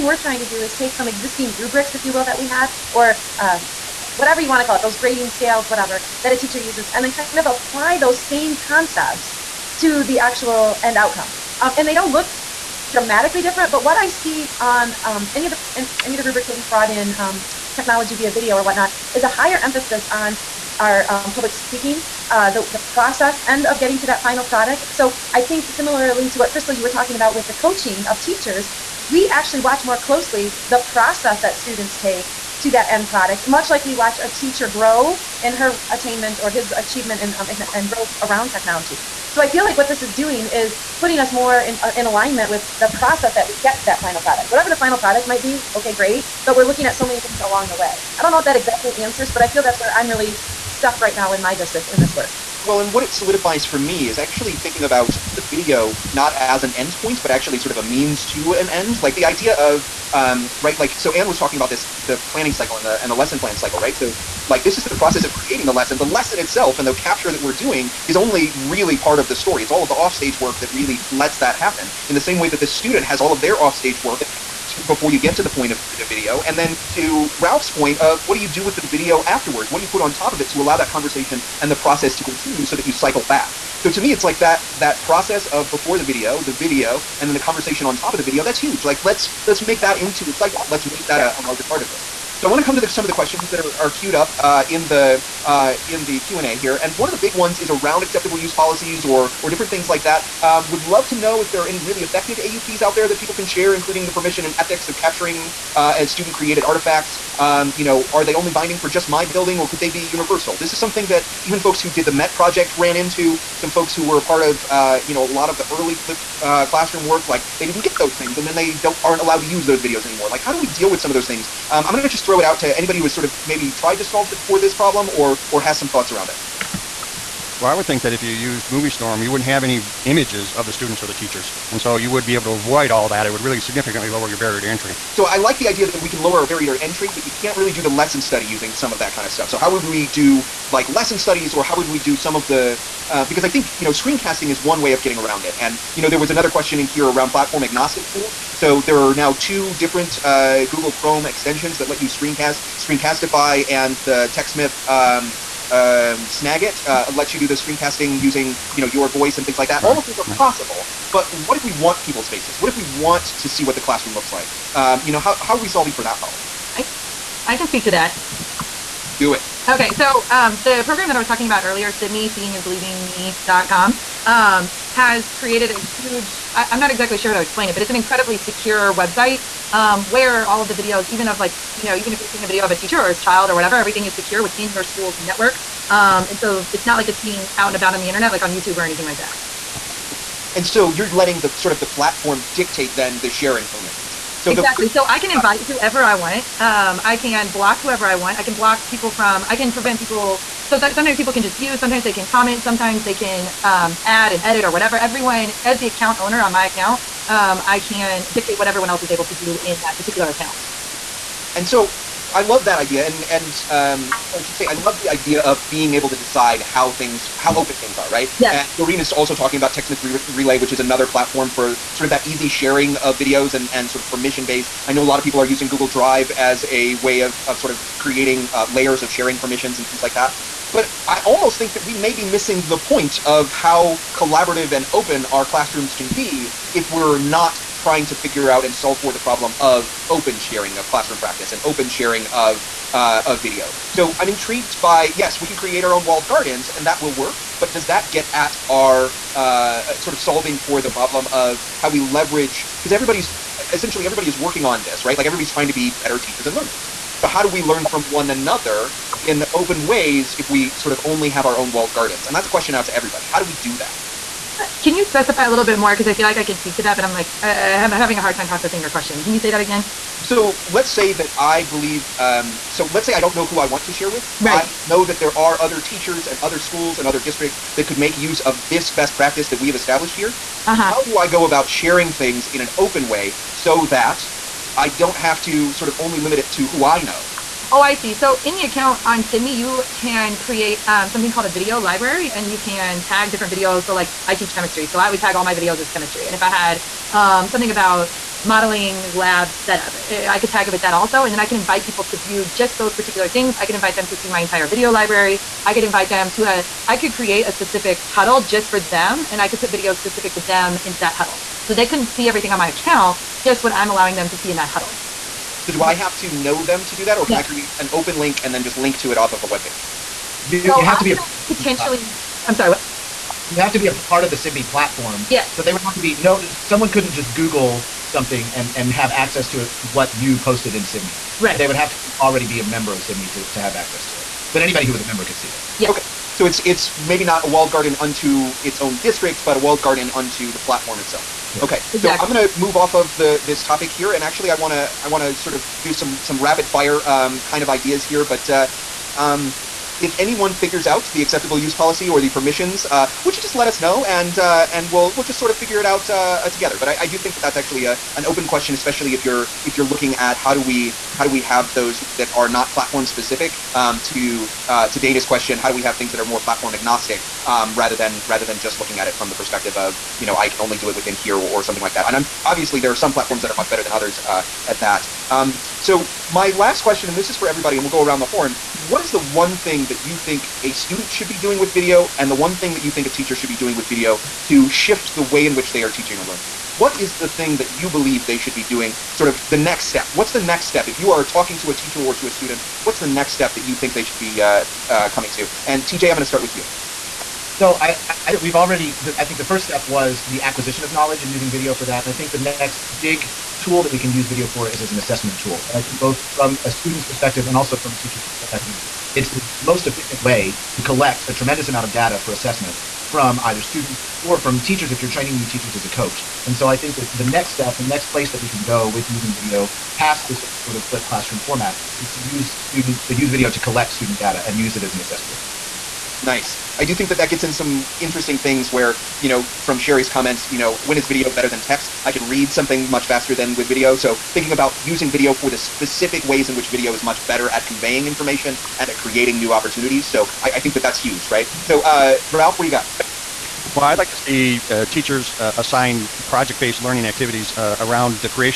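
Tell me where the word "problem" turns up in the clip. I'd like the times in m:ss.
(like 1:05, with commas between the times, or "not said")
2:04, 2:46, 3:59, 4:10.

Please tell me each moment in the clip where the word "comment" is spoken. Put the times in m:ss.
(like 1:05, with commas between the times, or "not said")
3:22, 7:10.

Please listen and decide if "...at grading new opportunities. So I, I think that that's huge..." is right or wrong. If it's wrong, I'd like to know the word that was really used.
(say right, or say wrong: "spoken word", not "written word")
wrong: "creating", not "grading".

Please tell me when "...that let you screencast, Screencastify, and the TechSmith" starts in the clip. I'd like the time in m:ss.
2:31.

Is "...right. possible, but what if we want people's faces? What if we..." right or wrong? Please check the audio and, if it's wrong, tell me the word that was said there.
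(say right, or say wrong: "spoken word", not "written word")
right.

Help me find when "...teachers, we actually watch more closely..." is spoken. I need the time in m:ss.
0:28.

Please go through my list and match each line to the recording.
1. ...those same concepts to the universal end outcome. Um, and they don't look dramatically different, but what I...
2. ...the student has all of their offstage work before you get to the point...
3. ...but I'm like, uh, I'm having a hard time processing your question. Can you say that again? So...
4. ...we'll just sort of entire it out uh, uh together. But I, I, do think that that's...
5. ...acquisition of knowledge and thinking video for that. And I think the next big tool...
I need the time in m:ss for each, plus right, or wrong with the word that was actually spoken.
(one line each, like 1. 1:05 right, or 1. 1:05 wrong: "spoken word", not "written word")
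1. 0:07 wrong: "actual", not "universal"
2. 1:12 right
3. 4:26 right
4. 5:55 wrong: "figure", not "entire"
5. 6:40 wrong: "using", not "thinking".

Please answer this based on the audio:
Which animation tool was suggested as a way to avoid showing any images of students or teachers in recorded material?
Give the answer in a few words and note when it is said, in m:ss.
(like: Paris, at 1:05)
MovieStorm, at 2:08.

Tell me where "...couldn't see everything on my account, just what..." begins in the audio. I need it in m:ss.
5:11.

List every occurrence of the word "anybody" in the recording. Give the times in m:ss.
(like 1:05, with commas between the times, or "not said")
2:02, 5:34.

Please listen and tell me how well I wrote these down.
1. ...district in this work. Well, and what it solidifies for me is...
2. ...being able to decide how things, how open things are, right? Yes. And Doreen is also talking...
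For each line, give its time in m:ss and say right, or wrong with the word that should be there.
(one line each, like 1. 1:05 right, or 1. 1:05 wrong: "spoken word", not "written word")
1. 0:51 right
2. 3:35 right.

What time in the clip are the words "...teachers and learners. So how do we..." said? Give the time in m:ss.
4:16.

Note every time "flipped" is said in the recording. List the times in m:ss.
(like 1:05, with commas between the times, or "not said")
1:55, 7:00.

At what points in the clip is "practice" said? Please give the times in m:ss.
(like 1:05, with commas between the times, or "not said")
4:01, 4:39.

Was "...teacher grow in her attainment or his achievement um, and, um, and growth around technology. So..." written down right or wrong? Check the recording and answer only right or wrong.
right.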